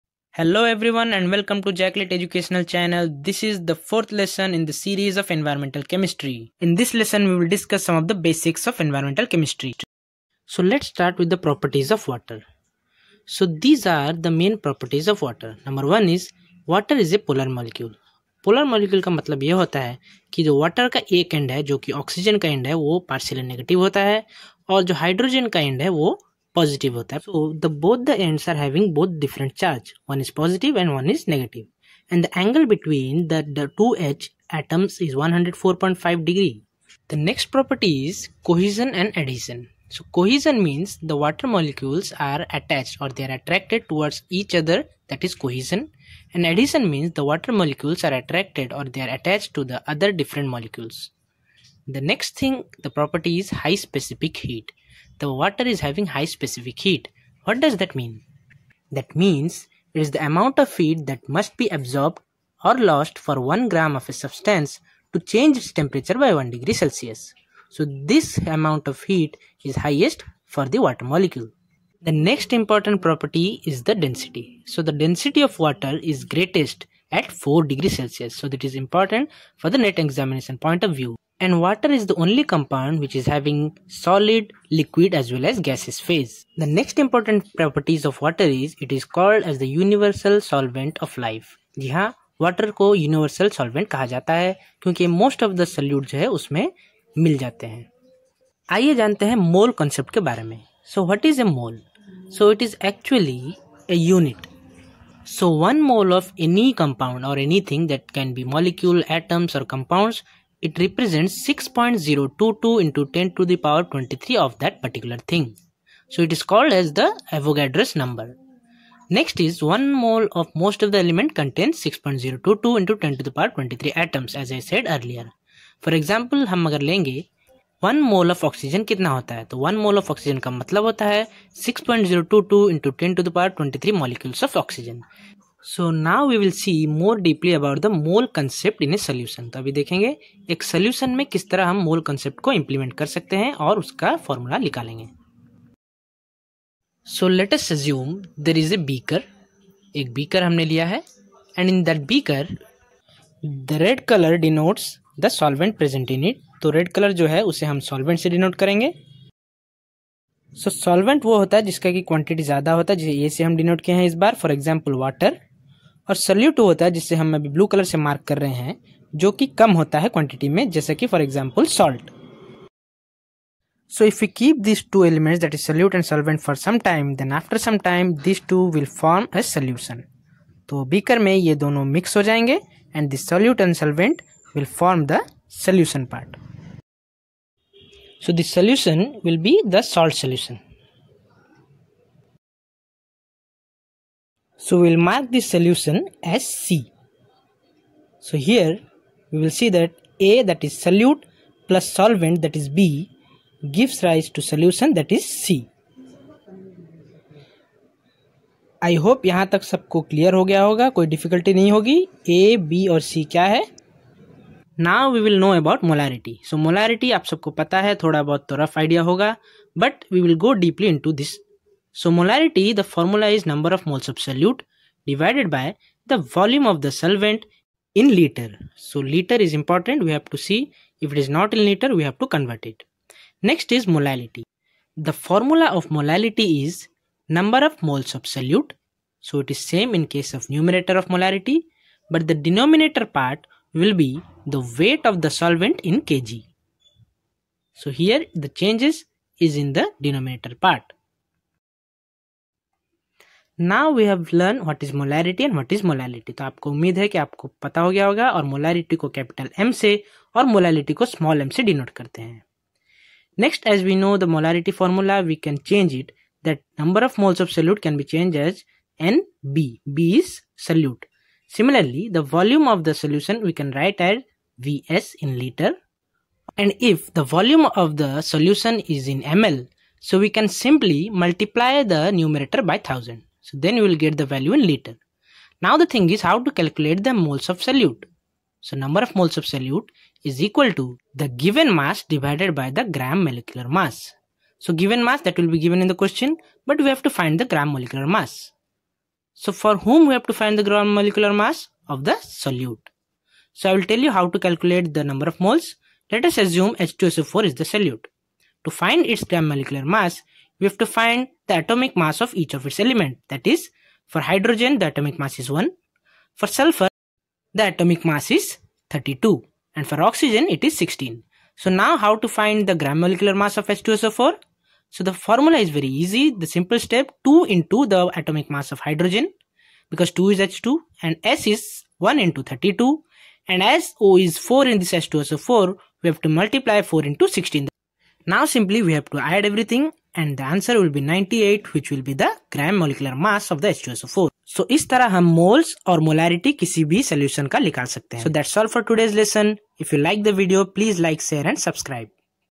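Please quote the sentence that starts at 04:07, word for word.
So here the changes is in the denominator part.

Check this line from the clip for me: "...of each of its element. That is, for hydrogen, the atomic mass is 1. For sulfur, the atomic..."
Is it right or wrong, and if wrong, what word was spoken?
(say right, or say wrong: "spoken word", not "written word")
right.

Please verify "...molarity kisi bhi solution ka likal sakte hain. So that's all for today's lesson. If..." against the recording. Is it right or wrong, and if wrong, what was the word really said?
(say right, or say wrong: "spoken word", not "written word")
right.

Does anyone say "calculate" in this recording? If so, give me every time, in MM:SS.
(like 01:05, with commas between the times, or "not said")
04:46, 05:04.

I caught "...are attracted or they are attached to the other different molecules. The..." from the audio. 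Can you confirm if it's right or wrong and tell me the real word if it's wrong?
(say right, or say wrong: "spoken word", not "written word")
right.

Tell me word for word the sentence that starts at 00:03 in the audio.
This is the fourth lesson in the series of environmental chemistry.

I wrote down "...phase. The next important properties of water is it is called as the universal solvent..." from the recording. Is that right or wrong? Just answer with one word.
right.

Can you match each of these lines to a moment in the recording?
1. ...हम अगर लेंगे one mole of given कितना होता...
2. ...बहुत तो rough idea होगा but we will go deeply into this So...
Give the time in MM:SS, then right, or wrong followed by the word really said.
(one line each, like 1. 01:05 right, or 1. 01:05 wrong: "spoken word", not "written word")
1. 02:06 wrong: "oxygen", not "given"
2. 03:38 right.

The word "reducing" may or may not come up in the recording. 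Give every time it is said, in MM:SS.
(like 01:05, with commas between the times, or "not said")
not said.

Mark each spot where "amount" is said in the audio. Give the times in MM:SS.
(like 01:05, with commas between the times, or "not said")
01:00, 01:08.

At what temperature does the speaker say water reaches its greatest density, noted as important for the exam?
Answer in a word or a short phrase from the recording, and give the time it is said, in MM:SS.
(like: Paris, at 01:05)
4 degrees Celsius, at 01:17.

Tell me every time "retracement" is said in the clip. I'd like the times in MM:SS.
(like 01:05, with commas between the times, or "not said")
not said.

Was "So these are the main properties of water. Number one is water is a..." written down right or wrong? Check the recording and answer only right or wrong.
right.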